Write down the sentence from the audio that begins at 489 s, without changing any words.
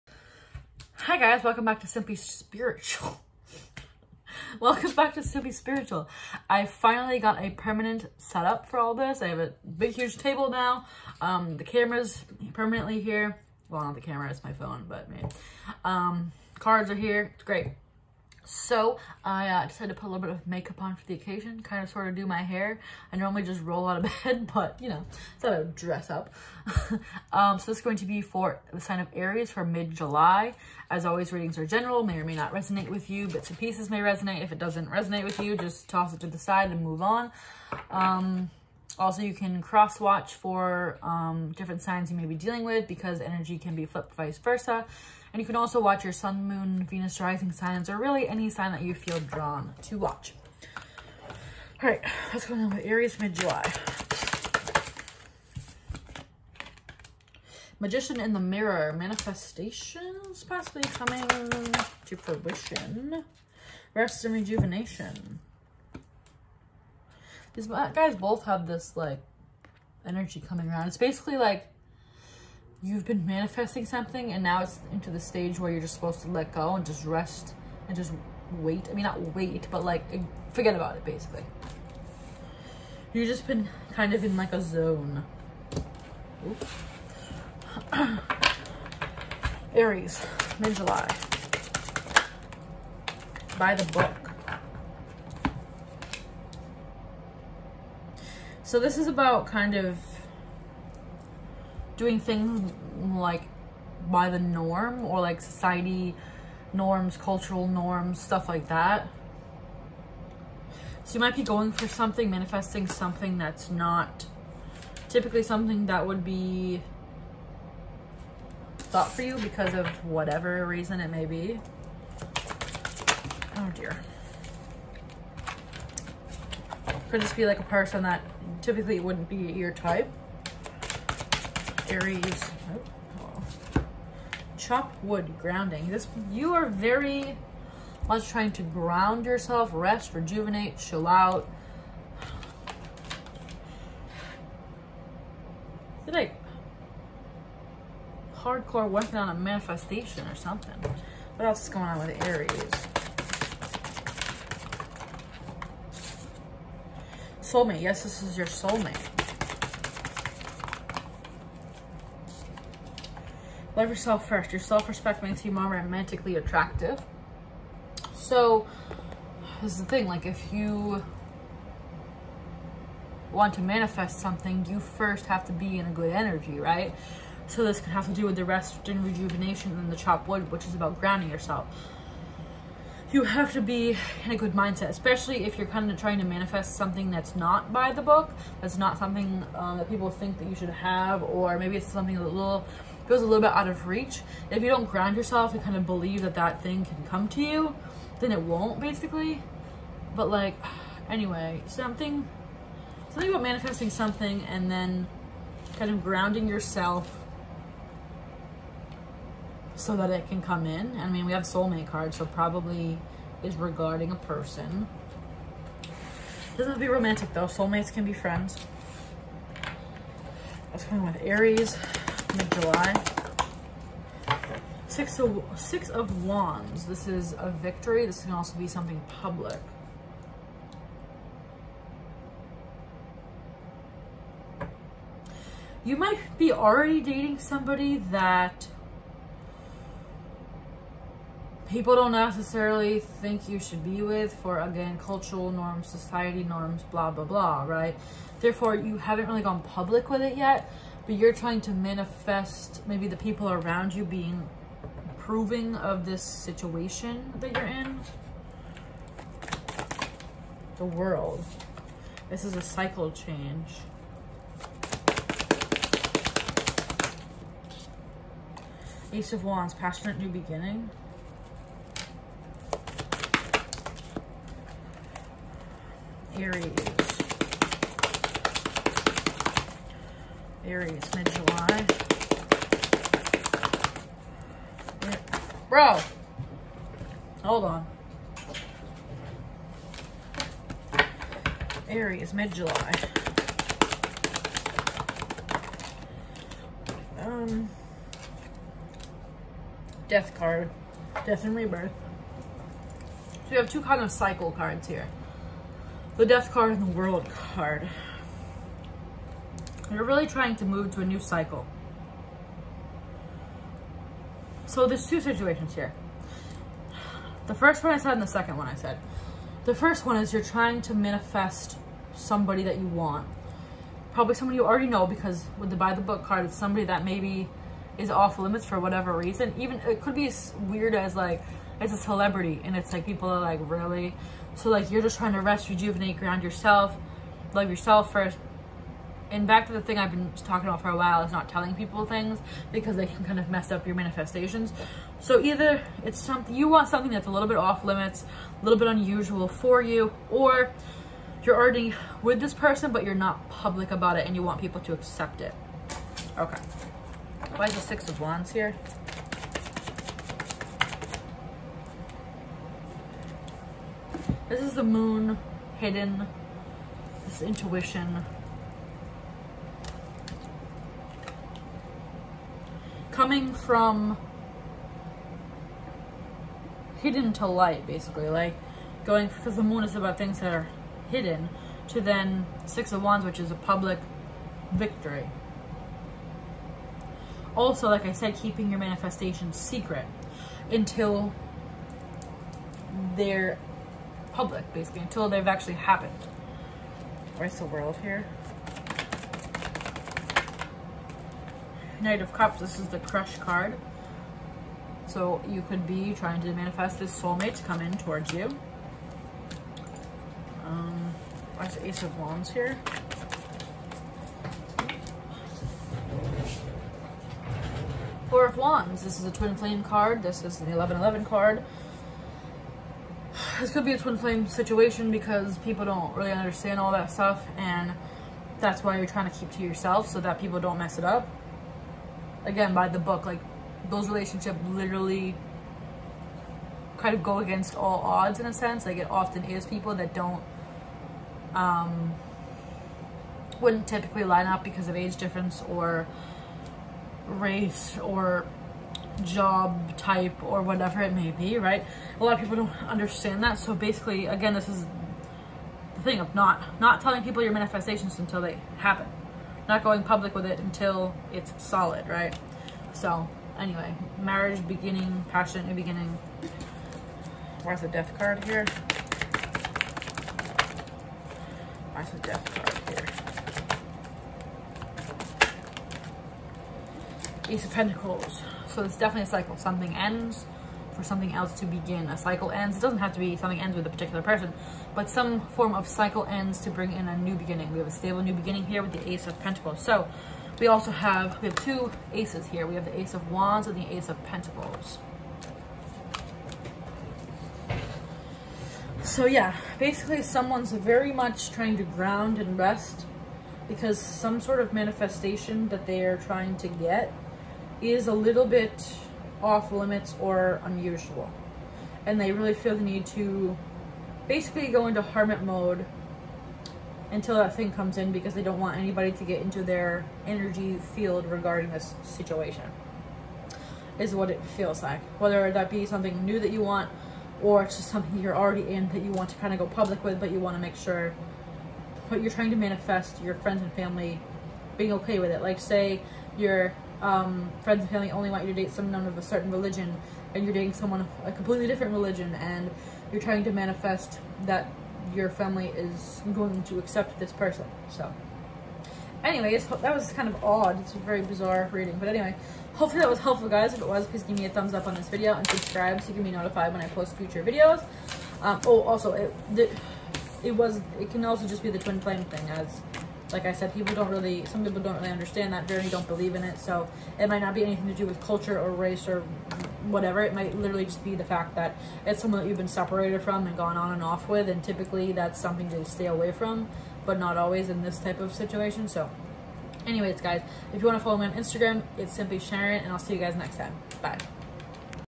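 So we also have, we have two aces here.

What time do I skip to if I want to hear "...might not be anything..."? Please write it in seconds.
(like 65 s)
567 s.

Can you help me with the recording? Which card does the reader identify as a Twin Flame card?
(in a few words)
Four of Wands.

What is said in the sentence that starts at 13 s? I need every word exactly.
Well, not the camera, it's my phone, but man.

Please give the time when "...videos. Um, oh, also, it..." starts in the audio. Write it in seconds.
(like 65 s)
557 s.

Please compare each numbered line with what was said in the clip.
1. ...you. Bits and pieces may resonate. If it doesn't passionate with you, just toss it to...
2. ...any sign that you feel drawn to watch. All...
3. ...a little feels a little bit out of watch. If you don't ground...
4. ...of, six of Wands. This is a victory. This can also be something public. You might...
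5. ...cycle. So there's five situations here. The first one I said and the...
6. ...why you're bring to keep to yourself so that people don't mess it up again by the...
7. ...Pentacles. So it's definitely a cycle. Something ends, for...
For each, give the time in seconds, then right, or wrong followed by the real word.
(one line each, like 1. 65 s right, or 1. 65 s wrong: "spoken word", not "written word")
1. 33 s wrong: "resonate", not "passionate"
2. 48 s right
3. 192 s wrong: "reach", not "watch"
4. 225 s right
5. 311 s wrong: "two", not "five"
6. 428 s wrong: "trying", not "bring"
7. 477 s right.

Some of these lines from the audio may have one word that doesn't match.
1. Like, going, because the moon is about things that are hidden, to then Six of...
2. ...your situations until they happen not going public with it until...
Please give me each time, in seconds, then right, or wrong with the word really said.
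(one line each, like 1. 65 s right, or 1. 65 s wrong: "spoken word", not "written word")
1. 378 s right
2. 457 s wrong: "manifestations", not "situations".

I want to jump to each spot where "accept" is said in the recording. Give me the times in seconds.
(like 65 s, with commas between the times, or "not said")
354 s, 546 s.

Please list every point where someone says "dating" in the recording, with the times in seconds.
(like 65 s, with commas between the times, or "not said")
237 s, 540 s.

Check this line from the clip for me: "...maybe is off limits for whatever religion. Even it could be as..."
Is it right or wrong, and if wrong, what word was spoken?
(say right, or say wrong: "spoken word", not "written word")
wrong: "reason", not "religion".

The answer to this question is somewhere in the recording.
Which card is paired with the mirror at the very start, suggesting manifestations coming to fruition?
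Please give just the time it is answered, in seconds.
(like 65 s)
57 s.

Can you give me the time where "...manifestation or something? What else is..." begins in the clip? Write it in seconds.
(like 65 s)
149 s.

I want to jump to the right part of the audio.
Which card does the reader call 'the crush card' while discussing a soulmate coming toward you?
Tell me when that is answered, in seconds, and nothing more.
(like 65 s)
402 s.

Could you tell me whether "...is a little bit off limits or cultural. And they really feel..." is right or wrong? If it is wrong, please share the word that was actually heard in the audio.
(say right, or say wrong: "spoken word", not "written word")
wrong: "unusual", not "cultural".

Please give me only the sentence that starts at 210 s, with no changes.
I mean, we have soulmate cards, so probably is regarding a person.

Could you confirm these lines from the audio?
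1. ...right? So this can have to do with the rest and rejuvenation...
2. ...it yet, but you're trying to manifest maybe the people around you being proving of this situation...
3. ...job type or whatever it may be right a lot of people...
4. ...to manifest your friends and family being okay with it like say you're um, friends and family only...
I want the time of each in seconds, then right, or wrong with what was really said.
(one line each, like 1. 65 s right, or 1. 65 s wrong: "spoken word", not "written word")
1. 176 s right
2. 250 s right
3. 449 s right
4. 532 s right.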